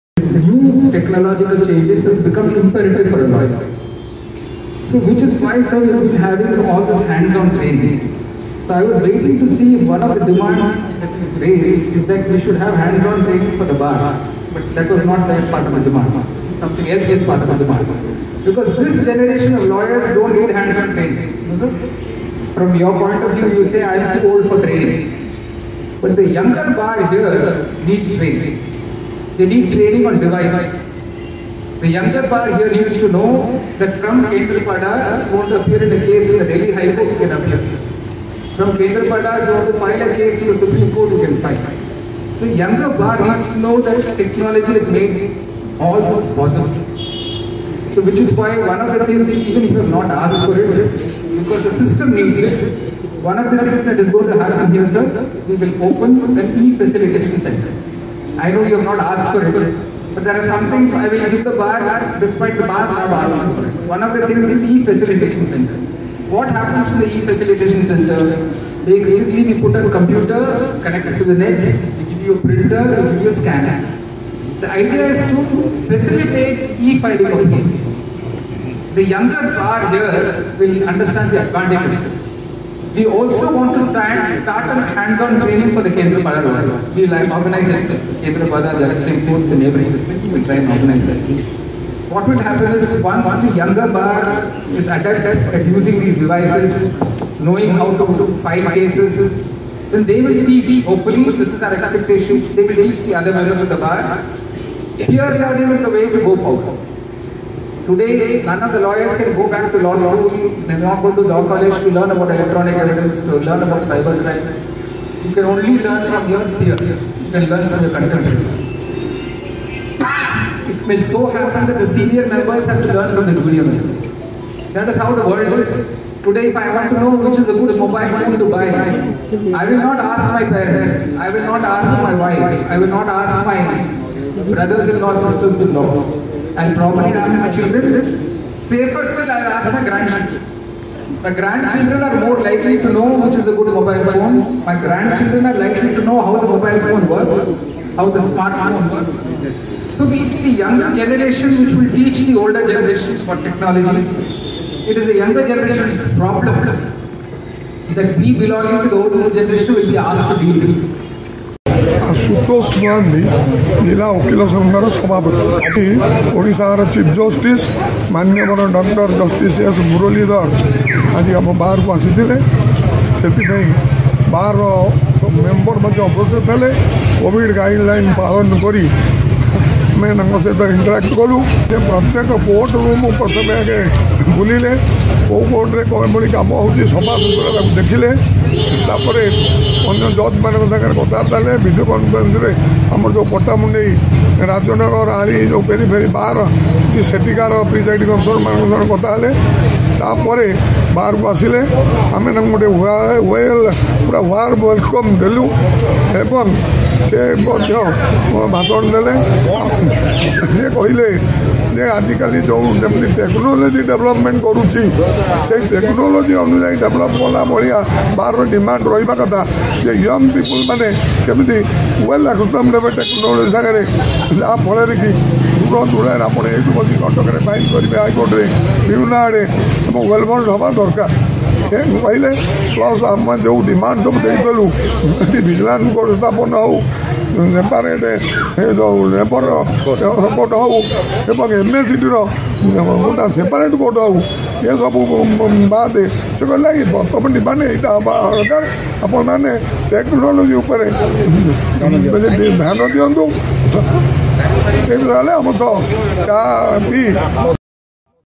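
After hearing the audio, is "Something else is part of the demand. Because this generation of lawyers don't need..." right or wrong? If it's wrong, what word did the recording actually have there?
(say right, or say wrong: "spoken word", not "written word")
right.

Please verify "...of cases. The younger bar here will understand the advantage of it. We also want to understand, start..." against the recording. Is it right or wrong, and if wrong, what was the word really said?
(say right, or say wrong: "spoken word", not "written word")
wrong: "stand", not "understand".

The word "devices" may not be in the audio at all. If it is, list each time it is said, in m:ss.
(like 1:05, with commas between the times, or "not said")
0:30, 1:36.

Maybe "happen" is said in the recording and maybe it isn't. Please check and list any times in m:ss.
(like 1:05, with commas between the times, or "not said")
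0:54, 1:06, 1:32, 2:01.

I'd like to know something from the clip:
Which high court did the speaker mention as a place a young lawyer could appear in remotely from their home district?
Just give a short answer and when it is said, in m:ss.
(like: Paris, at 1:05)
Delhi High Court, at 0:36.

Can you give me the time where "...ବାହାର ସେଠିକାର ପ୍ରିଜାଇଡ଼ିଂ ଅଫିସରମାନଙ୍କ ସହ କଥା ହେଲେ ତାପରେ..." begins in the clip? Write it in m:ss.
3:16.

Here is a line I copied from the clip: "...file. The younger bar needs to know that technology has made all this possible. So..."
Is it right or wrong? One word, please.
right.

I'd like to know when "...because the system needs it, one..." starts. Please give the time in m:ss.
0:51.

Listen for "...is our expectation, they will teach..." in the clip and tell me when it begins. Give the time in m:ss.
1:41.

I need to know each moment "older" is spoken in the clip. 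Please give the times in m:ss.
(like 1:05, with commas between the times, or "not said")
2:32, 2:39.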